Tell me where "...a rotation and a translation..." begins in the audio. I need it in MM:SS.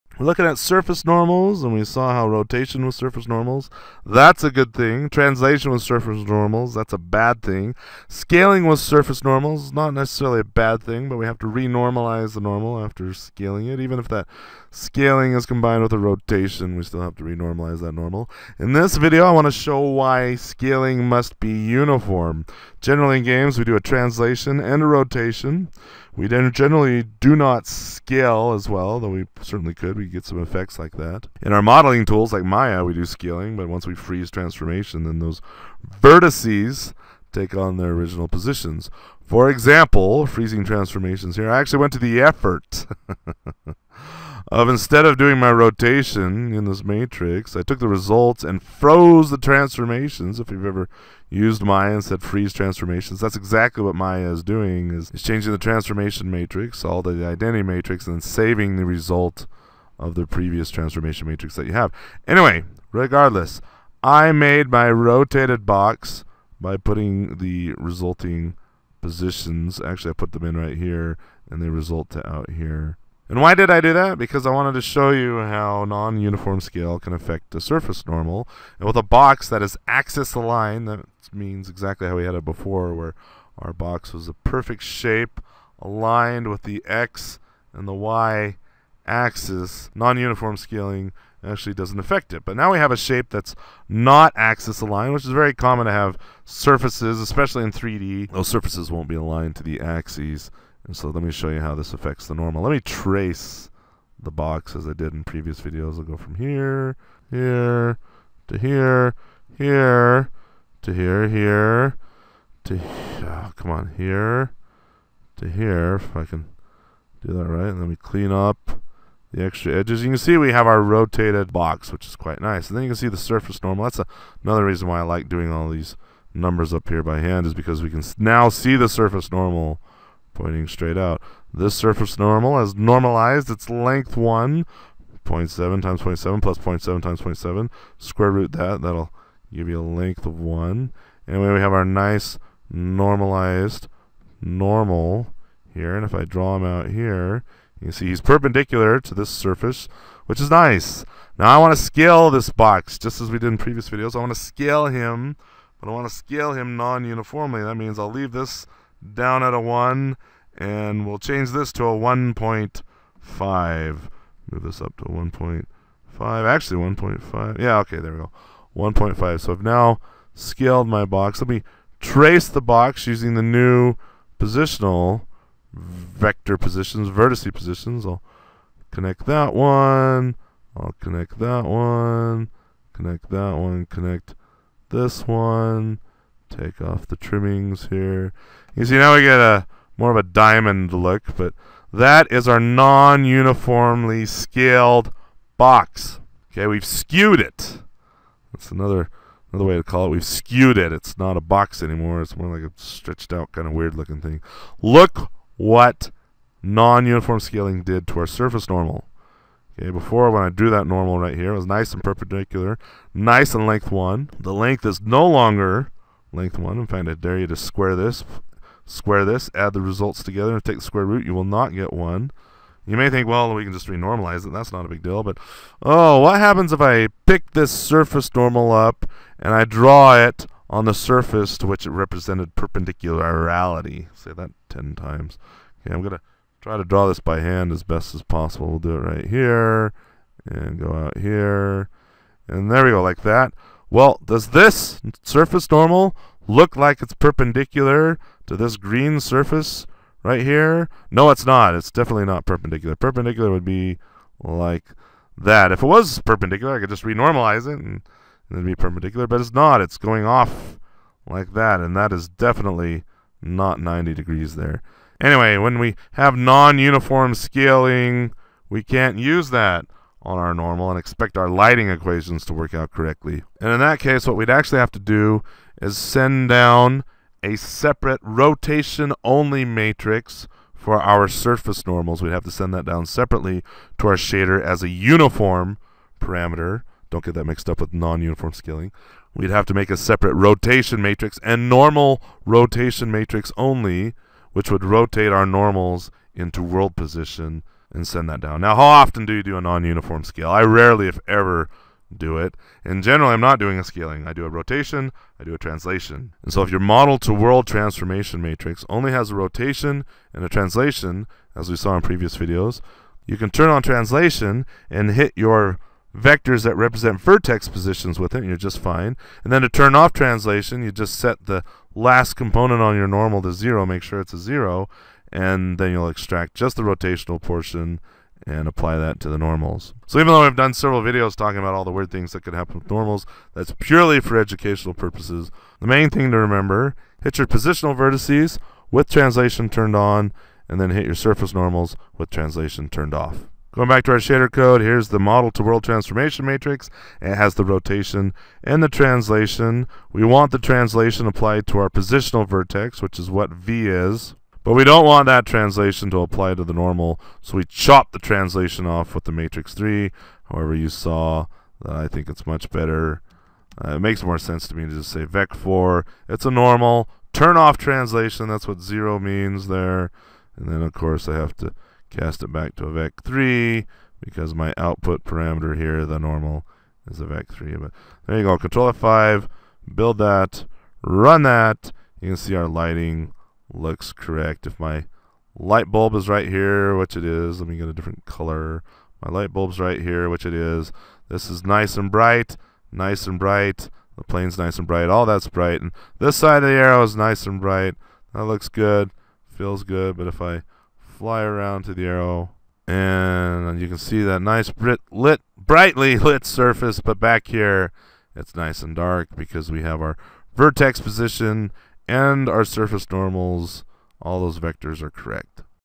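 05:09.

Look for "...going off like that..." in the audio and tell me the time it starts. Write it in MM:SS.
04:19.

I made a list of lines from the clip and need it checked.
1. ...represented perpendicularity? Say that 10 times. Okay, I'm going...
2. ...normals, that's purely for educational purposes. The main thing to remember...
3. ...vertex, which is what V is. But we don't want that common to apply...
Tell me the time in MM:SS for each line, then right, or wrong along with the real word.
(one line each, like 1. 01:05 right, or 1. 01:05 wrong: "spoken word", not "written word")
1. 03:51 right
2. 05:32 right
3. 05:52 wrong: "translation", not "common".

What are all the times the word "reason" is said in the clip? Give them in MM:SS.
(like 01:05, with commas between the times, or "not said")
02:04.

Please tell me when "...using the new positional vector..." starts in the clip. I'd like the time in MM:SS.
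02:53.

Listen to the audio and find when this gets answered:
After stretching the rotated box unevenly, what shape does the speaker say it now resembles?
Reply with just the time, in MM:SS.
03:10.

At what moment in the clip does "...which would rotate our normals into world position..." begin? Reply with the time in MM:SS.
04:54.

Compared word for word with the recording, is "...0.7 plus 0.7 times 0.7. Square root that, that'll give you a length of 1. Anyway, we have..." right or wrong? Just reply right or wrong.
right.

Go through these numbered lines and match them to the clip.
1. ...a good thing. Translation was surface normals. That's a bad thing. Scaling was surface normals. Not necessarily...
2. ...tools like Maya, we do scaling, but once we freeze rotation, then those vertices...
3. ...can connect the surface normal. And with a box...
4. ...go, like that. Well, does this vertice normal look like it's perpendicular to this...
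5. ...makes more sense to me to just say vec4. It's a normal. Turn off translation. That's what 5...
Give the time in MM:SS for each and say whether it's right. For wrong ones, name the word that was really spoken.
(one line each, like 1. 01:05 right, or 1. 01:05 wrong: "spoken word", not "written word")
1. 00:04 right
2. 00:32 wrong: "transformation", not "rotation"
3. 01:16 wrong: "affect", not "connect"
4. 04:02 wrong: "surface", not "vertice"
5. 06:03 wrong: "0", not "5".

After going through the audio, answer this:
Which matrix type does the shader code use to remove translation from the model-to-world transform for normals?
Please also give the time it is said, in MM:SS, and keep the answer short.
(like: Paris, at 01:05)
matrix 3, at 05:59.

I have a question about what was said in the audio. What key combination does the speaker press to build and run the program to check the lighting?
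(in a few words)
Control F5.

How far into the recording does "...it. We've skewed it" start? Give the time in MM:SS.
03:20.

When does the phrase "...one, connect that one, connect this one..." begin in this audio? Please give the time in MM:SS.
03:01.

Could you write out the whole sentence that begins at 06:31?
This is nice and bright, nice and bright.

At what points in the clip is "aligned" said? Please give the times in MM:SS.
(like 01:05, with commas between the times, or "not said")
01:20, 01:25, 01:34, 01:39.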